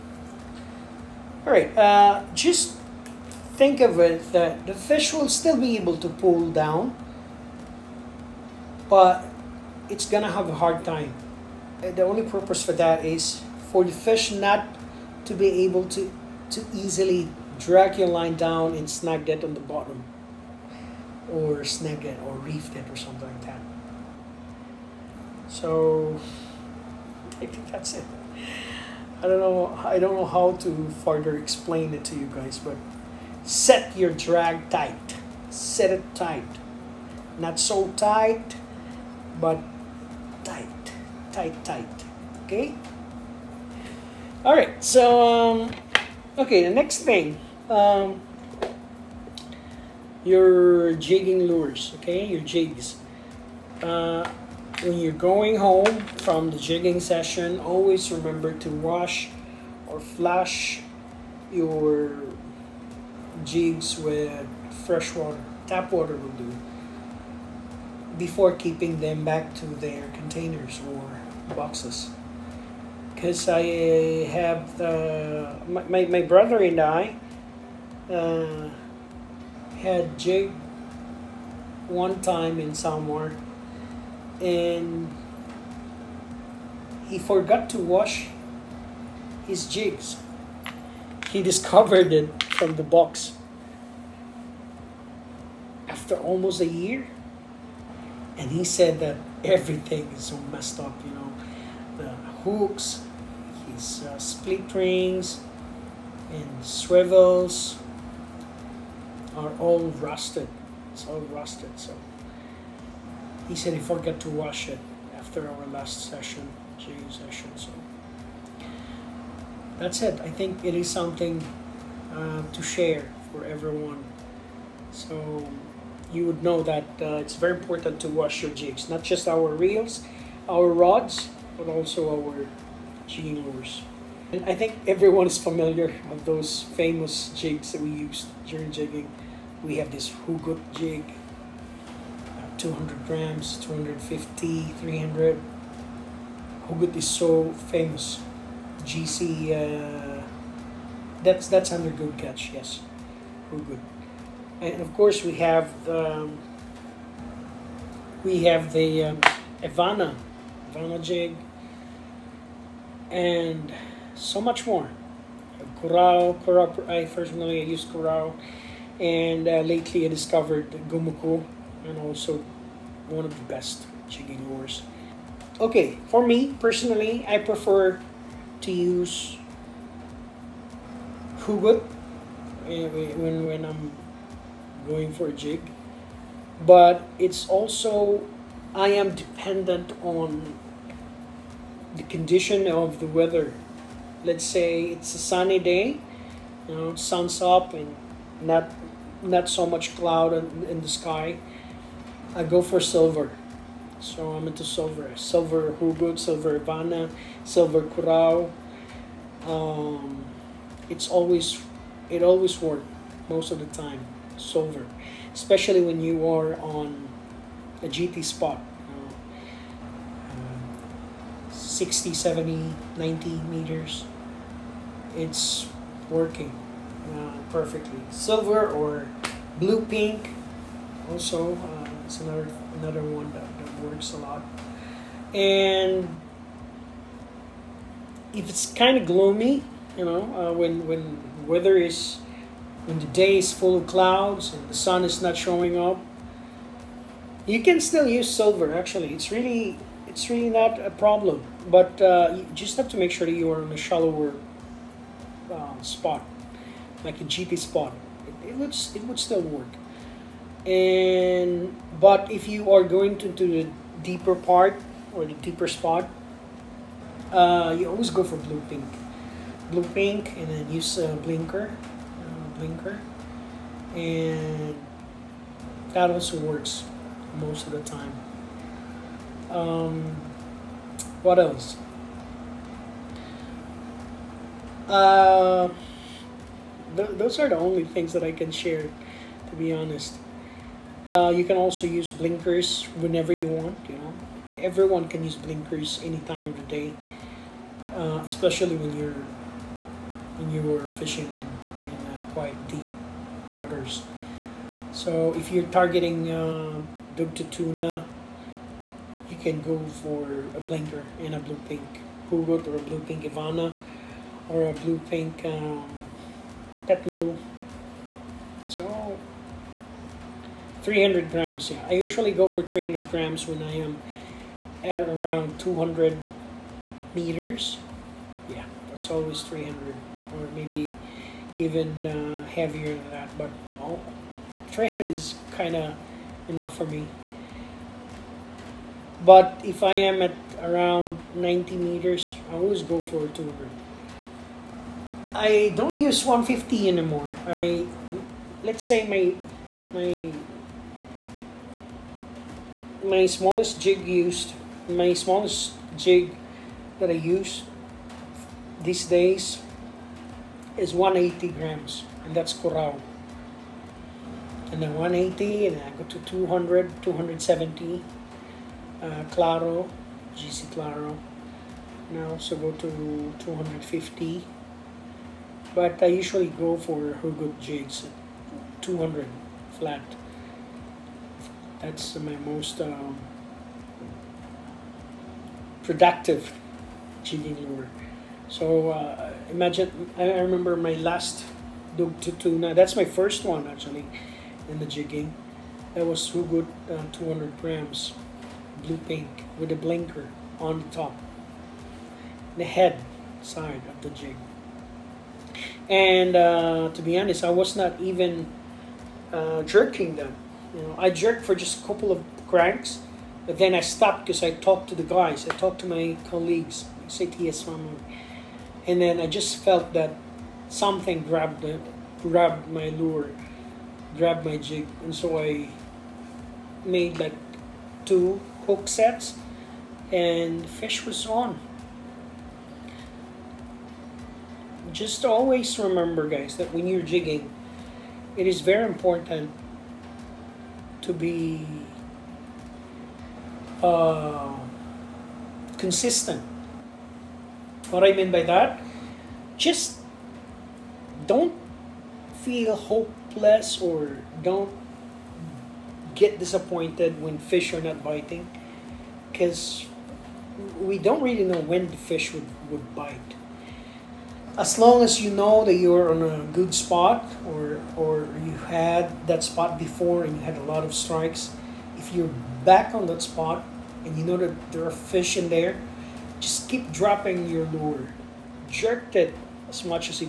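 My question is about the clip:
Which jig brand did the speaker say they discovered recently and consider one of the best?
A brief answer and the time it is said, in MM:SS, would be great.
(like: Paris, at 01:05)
Gumuku, at 02:50.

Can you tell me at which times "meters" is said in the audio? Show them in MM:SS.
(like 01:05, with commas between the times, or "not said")
03:43, 05:27, 05:41.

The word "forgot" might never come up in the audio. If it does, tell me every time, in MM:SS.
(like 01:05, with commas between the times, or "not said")
01:27, 01:53.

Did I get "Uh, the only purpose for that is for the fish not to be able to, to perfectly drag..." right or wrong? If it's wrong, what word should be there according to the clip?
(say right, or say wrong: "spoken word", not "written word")
wrong: "easily", not "perfectly".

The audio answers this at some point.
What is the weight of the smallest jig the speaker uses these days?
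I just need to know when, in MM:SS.
06:00.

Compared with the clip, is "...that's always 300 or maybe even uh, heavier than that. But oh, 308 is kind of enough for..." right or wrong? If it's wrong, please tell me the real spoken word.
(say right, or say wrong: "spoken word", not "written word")
wrong: "300", not "308".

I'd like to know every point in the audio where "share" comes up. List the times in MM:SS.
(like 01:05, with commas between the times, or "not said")
02:02, 04:48.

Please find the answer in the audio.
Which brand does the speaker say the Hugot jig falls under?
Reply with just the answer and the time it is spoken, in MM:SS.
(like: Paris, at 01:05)
Good Catch, at 02:31.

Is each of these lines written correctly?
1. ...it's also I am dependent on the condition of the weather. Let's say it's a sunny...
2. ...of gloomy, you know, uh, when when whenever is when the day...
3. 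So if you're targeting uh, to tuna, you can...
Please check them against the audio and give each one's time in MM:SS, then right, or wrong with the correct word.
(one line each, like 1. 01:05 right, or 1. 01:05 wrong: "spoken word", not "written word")
1. 03:07 right
2. 03:58 wrong: "weather", not "whenever"
3. 05:04 right.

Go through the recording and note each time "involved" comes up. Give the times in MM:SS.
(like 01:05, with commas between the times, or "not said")
not said.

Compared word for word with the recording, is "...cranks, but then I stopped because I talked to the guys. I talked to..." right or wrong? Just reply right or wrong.
right.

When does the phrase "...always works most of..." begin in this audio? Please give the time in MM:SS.
03:32.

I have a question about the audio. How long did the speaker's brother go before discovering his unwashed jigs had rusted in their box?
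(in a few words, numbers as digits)
almost a year.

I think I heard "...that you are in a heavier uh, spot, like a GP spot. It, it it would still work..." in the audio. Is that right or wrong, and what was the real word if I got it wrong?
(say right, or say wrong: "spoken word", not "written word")
wrong: "shallower", not "heavier".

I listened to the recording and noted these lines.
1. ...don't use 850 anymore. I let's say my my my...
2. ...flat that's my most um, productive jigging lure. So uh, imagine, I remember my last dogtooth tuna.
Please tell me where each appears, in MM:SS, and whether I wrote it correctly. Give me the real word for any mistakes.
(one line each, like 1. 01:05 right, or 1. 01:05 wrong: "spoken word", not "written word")
1. 05:45 wrong: "150", not "850"
2. 06:19 right.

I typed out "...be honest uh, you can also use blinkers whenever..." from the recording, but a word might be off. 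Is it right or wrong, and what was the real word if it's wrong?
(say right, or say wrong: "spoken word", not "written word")
right.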